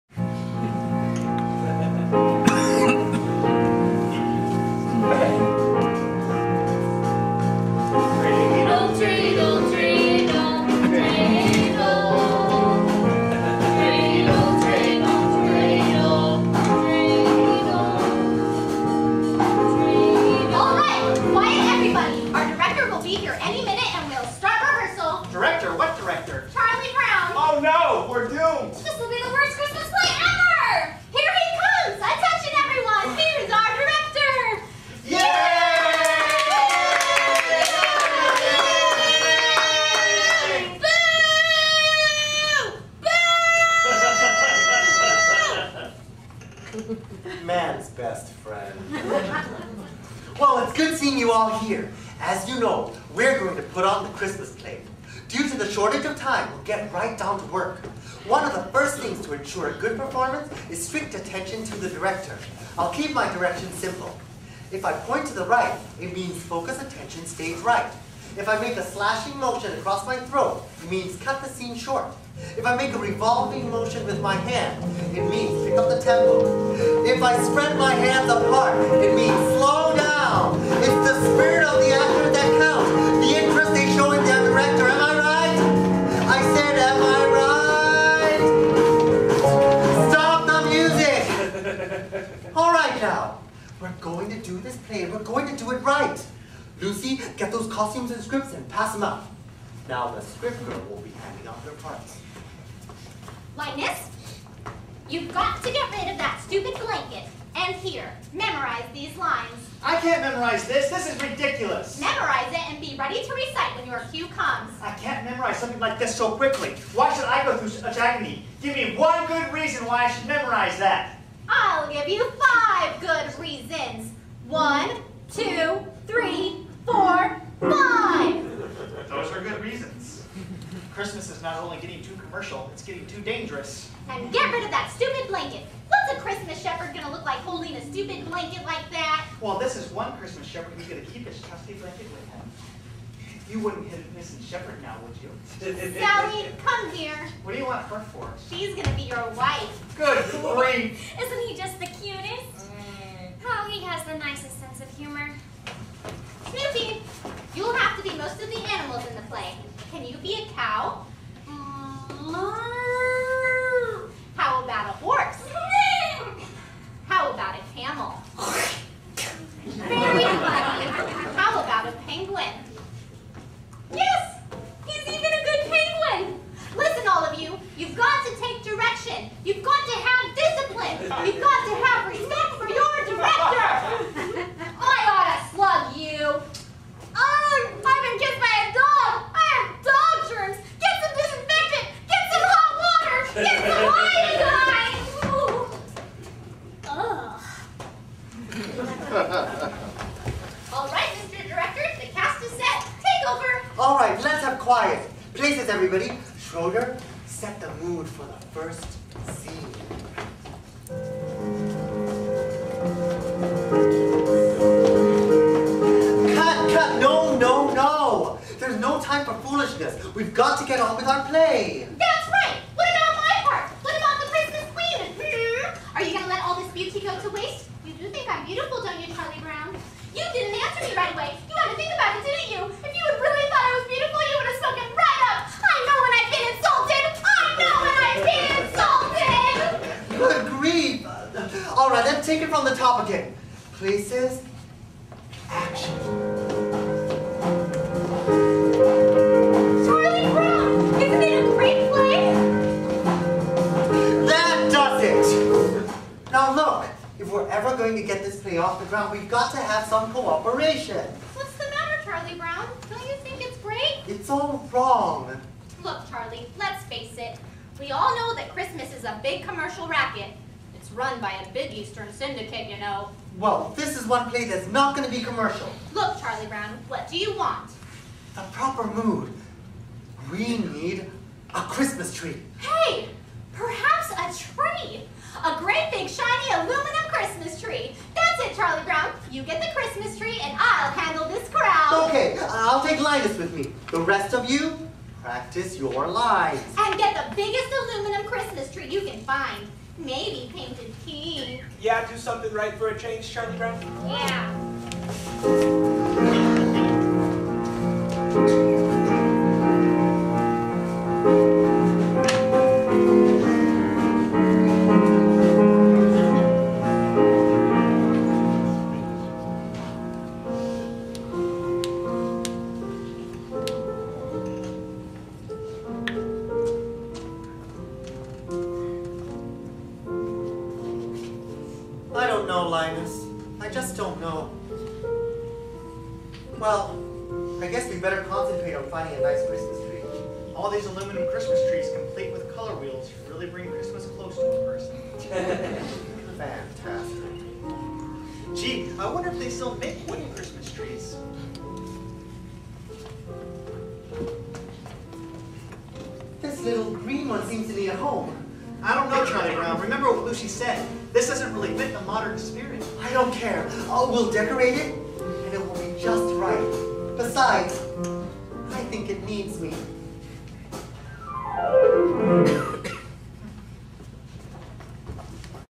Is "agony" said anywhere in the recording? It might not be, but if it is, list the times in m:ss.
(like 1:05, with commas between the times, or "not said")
1:57.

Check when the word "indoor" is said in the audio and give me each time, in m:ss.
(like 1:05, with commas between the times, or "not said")
not said.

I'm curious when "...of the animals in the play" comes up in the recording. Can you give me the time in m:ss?
2:38.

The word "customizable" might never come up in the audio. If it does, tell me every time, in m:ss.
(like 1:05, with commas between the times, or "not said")
not said.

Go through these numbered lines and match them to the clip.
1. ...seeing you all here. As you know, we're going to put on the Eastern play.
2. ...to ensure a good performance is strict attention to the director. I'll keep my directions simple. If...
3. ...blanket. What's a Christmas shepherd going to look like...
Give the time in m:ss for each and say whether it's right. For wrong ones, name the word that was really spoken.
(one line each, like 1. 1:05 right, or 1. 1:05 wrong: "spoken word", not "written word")
1. 0:50 wrong: "Christmas", not "Eastern"
2. 0:59 right
3. 2:15 right.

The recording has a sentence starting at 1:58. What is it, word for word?
Give me one good reason why I should memorize that.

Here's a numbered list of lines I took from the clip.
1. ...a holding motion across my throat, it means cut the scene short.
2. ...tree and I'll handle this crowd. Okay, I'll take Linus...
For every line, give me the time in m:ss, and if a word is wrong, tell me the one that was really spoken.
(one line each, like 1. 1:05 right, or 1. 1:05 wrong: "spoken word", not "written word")
1. 1:08 wrong: "slashing", not "holding"
2. 4:50 right.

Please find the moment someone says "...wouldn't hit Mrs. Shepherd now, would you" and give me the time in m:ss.
2:23.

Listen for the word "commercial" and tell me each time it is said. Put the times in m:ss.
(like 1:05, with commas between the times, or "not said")
2:12, 4:29, 4:35.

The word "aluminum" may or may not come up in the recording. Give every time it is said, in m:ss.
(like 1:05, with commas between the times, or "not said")
4:46, 4:57, 5:40.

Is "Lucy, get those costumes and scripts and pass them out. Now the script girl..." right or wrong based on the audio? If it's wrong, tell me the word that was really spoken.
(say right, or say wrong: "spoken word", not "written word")
right.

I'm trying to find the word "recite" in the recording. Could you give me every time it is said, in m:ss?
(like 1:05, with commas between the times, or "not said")
1:53.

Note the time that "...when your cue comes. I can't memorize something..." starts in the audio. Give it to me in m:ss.
1:53.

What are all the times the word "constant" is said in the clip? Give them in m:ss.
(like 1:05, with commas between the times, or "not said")
not said.